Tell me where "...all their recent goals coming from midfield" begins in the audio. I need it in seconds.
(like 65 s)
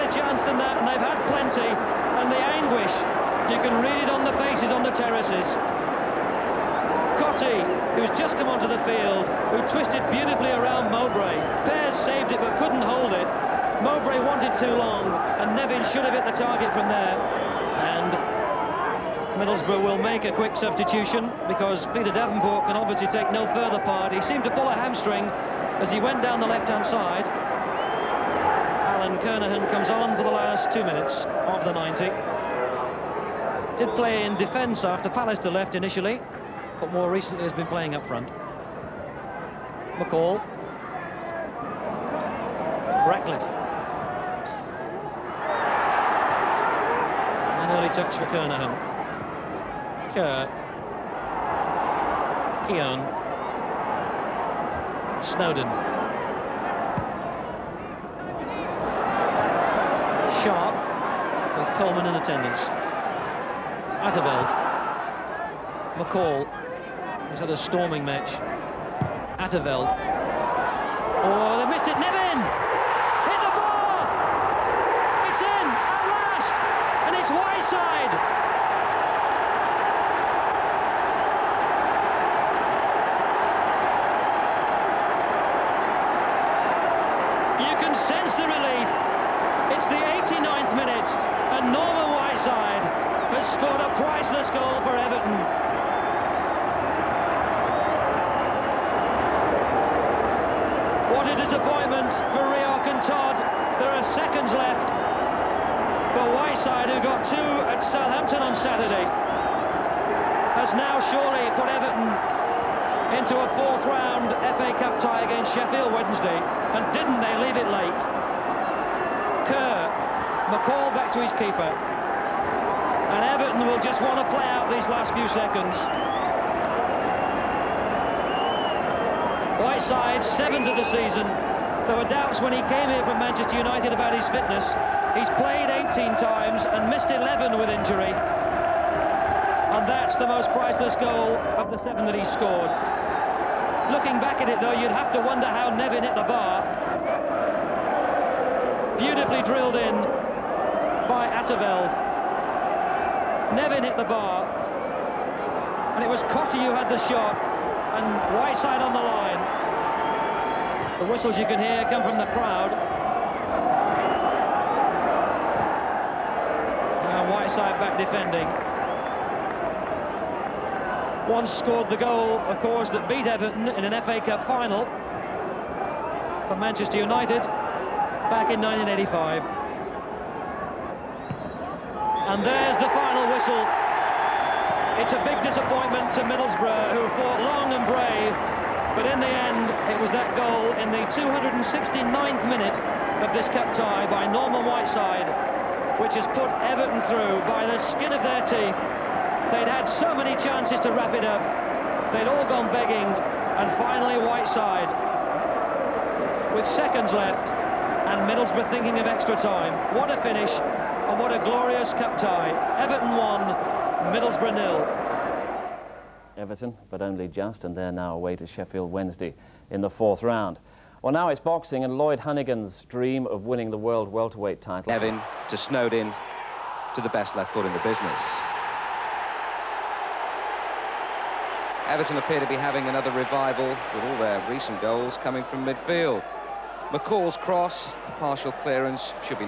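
234 s.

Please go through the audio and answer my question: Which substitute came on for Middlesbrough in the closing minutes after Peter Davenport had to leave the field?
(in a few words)
Brian Kernaghan.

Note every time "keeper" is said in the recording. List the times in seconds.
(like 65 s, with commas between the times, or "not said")
121 s.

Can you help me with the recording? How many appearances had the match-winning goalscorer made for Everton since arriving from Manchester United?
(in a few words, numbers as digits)
18.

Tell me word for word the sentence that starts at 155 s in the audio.
And it was Cottee who had the shot.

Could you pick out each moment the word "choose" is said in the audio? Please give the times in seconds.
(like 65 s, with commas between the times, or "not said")
not said.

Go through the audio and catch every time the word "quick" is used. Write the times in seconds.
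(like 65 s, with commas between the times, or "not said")
20 s.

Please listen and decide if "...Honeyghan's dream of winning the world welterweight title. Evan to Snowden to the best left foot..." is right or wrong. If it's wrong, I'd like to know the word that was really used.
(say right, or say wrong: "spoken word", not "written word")
right.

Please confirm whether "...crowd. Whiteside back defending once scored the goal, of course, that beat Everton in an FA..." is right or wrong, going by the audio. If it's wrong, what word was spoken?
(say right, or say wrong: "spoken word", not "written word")
right.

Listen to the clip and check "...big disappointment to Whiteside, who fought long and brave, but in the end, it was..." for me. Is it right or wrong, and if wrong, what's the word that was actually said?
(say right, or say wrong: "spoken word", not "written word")
wrong: "Middlesbrough", not "Whiteside".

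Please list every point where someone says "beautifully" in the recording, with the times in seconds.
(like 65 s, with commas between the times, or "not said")
10 s, 148 s.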